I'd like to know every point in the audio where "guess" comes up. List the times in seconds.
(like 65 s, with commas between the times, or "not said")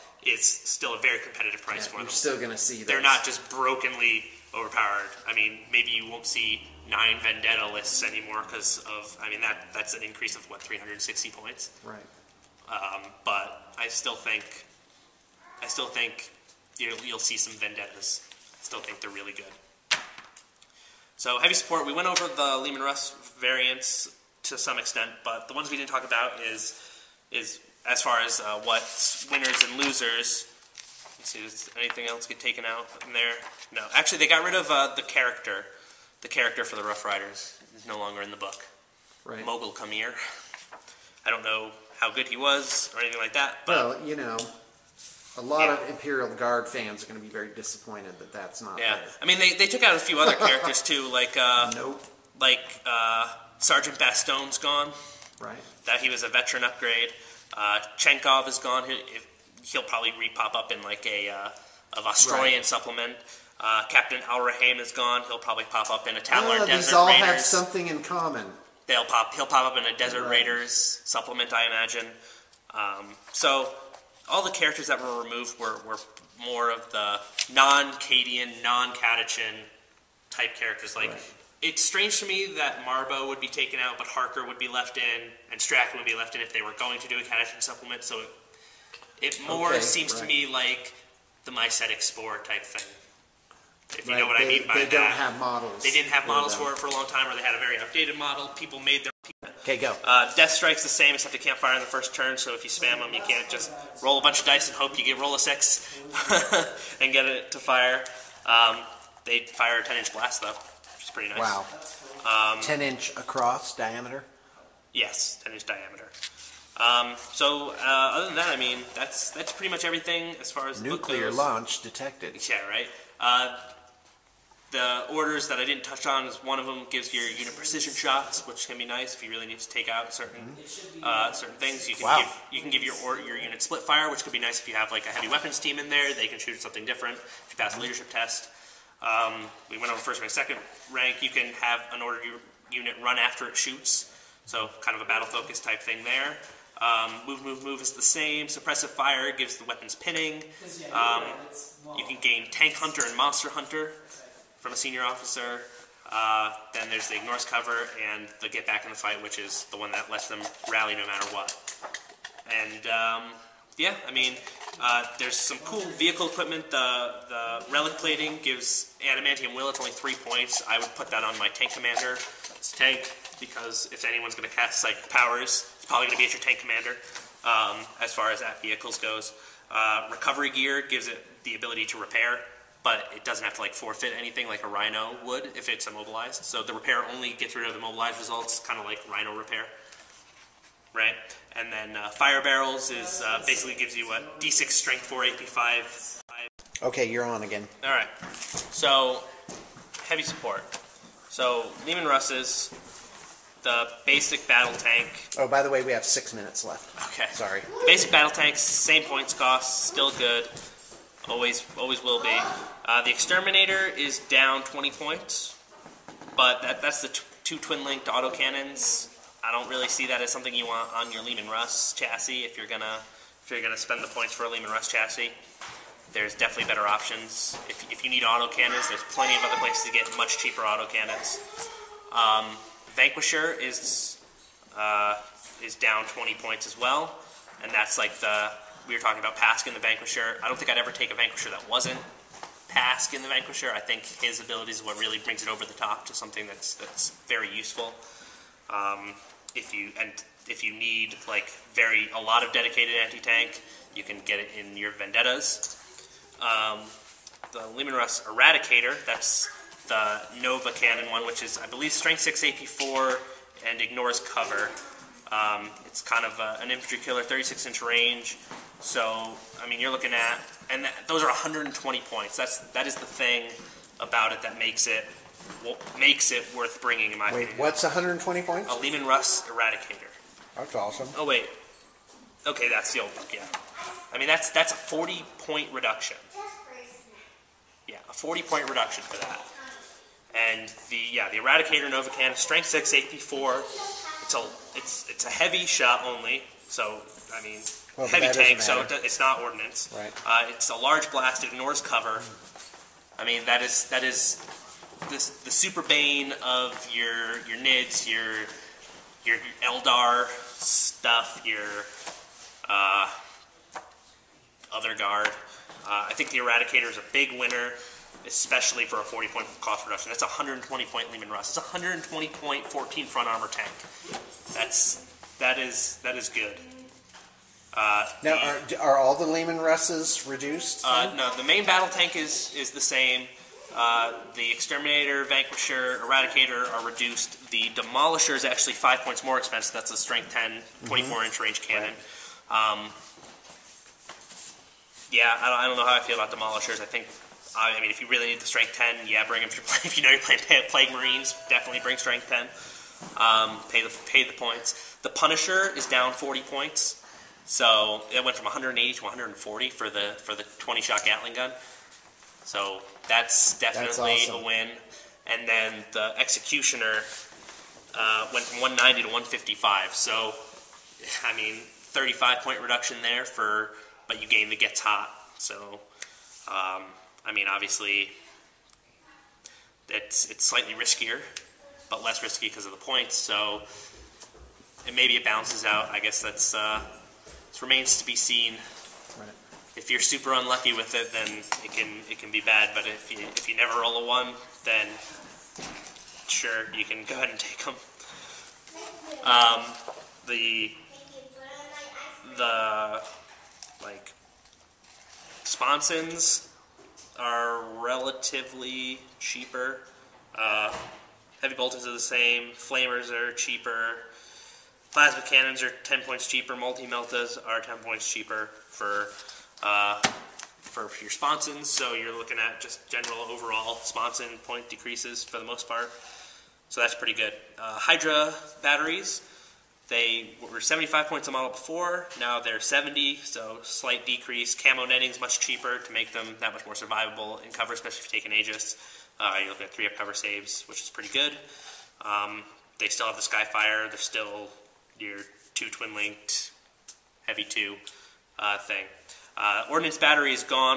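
385 s.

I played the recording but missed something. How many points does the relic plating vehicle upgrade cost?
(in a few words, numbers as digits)
3.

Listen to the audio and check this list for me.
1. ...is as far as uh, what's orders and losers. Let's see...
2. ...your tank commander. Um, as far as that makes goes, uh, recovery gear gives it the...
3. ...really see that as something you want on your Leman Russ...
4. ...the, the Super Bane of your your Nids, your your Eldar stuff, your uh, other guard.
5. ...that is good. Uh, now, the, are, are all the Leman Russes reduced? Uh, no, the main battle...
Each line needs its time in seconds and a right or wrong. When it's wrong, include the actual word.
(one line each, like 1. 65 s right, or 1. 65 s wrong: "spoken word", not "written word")
1. 27 s wrong: "winners", not "orders"
2. 176 s wrong: "vehicles", not "makes"
3. 219 s right
4. 305 s right
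5. 326 s right.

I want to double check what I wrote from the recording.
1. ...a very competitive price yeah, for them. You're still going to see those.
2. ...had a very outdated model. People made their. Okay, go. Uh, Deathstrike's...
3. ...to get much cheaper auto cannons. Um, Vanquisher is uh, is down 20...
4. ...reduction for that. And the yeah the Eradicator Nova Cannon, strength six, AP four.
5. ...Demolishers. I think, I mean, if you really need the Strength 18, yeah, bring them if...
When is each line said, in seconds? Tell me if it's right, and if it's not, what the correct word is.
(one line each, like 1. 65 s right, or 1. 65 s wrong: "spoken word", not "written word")
1. 0 s right
2. 97 s right
3. 229 s right
4. 288 s right
5. 346 s wrong: "10", not "18".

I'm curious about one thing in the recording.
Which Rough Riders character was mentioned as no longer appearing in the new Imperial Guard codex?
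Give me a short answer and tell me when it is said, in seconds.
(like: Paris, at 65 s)
Mogul Kamir, at 39 s.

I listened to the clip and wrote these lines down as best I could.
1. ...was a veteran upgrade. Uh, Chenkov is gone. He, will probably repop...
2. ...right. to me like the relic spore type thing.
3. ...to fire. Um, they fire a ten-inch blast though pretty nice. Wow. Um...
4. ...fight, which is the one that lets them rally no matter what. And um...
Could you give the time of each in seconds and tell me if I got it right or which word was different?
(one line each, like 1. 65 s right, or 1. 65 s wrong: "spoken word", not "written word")
1. 56 s right
2. 90 s wrong: "mycetic", not "relic"
3. 107 s right
4. 158 s right.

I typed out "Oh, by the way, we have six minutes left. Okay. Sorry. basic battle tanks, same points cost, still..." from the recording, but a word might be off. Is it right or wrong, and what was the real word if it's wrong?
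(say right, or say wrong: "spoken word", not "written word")
right.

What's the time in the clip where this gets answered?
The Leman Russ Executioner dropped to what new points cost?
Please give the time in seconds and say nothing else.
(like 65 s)
369 s.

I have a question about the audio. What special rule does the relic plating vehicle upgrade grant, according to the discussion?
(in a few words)
Adamantium will.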